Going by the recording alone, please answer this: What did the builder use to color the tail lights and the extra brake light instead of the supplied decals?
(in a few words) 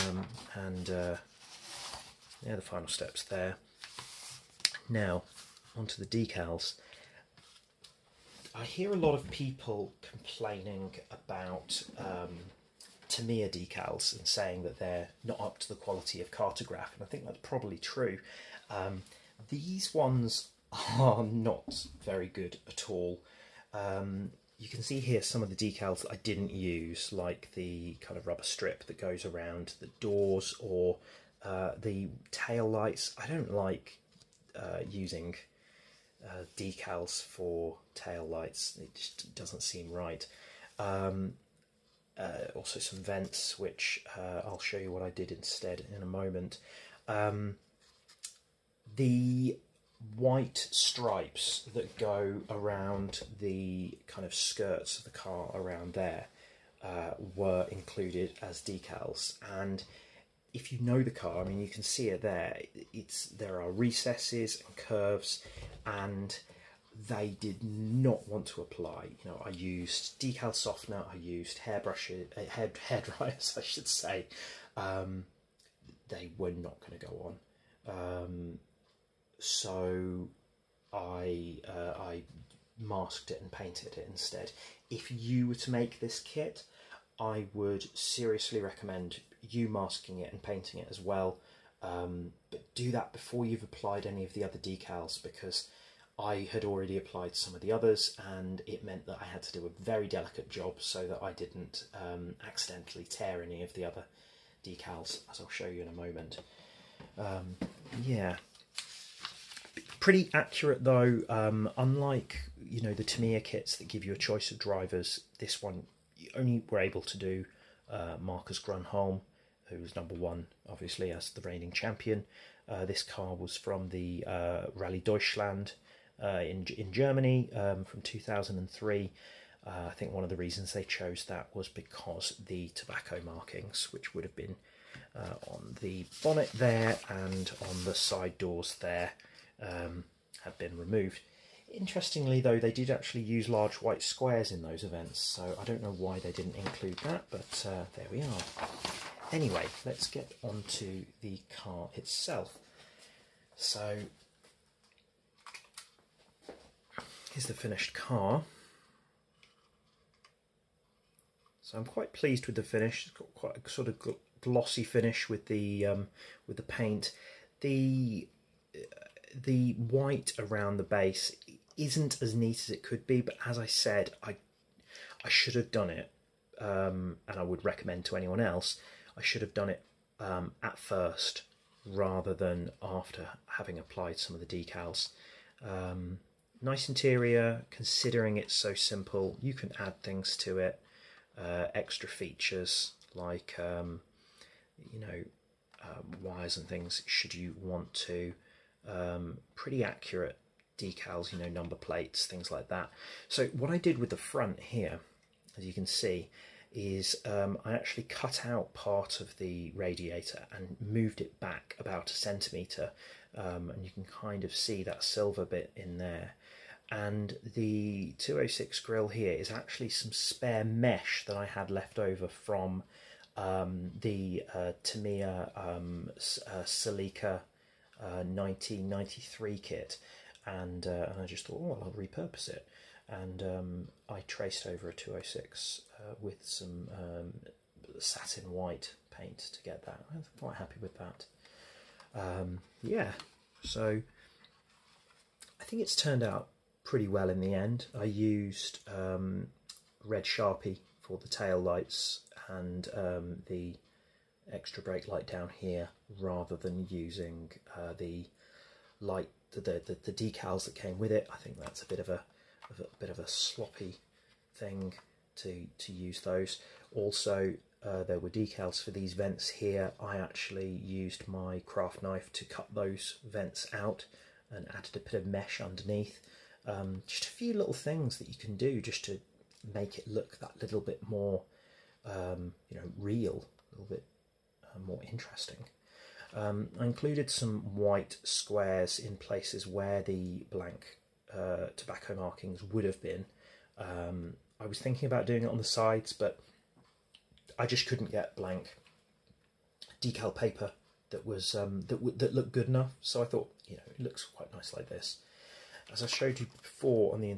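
Red Sharpie.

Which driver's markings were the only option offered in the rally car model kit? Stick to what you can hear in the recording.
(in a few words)
Marcus Gronholm.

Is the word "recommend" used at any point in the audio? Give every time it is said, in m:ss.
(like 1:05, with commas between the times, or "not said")
1:28, 2:57.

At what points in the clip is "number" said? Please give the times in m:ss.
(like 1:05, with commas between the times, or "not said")
1:59, 3:21.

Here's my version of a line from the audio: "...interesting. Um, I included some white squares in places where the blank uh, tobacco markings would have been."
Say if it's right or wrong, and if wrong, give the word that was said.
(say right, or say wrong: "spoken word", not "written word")
right.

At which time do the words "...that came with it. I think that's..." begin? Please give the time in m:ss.
4:20.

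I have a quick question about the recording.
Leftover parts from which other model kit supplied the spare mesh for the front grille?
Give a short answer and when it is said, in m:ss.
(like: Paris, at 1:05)
Tamiya Celica 1993, at 3:46.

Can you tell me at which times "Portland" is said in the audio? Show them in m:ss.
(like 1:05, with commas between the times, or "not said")
not said.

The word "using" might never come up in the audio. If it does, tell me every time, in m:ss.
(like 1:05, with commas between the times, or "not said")
0:34, 4:16.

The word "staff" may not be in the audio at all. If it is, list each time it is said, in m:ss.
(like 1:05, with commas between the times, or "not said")
not said.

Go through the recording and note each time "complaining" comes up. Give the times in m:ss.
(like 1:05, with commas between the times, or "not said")
0:10.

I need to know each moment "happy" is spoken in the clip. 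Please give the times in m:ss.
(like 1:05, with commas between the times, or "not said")
4:00.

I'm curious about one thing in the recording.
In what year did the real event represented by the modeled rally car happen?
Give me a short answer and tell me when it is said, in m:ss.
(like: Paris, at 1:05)
2003, at 2:08.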